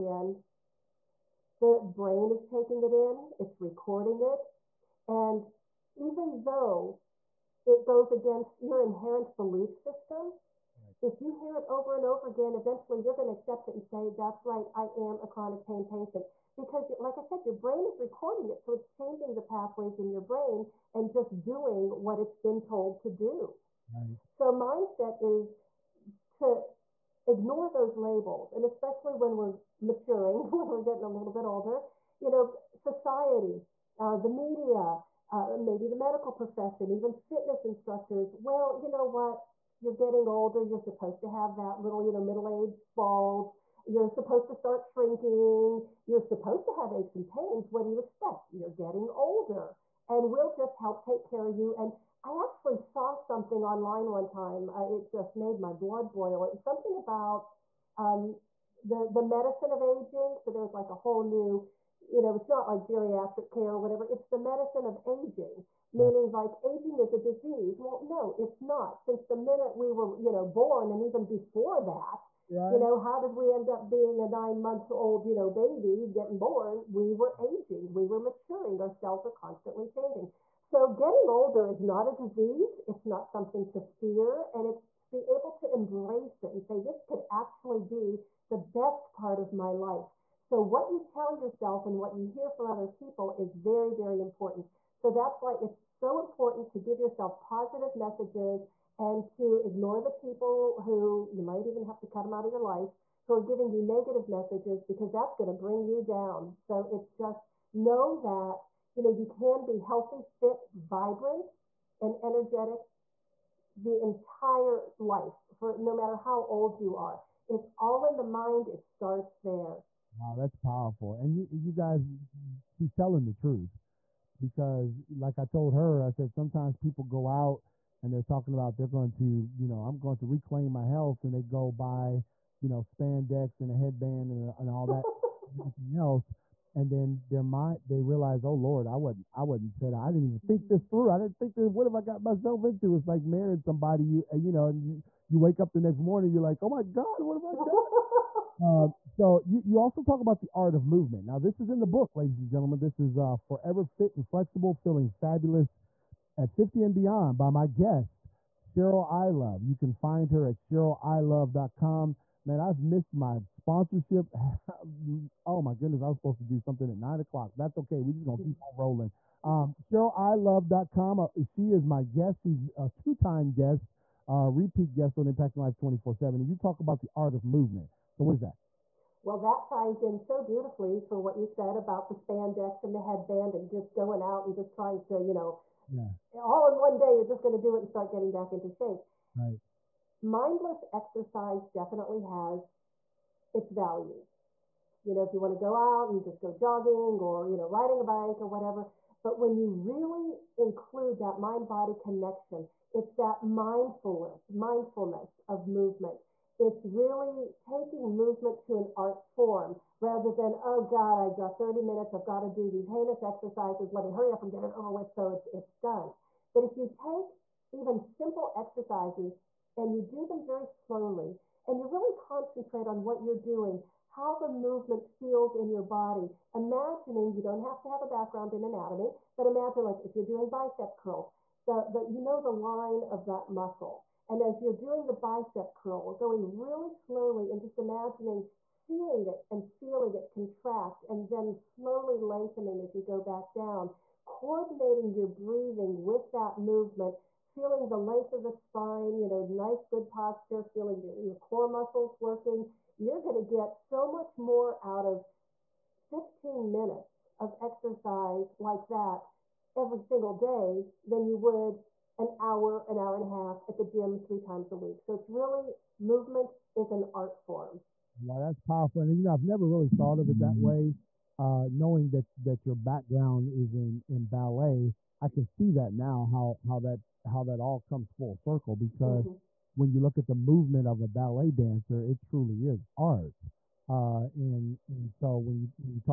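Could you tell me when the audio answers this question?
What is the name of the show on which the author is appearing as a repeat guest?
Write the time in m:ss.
2:55.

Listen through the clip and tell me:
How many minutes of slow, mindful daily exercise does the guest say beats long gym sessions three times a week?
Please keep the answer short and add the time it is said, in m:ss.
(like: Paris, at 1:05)
15, at 4:16.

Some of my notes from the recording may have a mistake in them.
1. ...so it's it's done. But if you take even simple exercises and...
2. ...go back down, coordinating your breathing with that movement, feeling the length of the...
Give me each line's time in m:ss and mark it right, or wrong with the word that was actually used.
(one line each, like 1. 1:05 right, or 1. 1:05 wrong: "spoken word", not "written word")
1. 3:35 right
2. 4:03 right.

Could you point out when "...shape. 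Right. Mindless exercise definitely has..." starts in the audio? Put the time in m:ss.
3:08.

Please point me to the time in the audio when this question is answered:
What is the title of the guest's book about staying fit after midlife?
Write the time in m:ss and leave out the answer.
2:33.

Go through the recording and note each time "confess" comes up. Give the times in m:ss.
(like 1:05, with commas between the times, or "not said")
not said.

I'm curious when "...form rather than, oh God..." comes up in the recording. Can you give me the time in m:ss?
3:29.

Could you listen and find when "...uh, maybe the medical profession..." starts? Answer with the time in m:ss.
0:35.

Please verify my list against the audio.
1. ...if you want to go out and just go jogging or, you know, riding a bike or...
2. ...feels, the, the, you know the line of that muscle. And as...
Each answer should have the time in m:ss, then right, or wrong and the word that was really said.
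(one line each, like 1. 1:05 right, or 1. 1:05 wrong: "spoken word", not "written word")
1. 3:15 right
2. 3:50 wrong: "curls", not "feels".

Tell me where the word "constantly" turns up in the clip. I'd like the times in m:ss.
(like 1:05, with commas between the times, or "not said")
1:19.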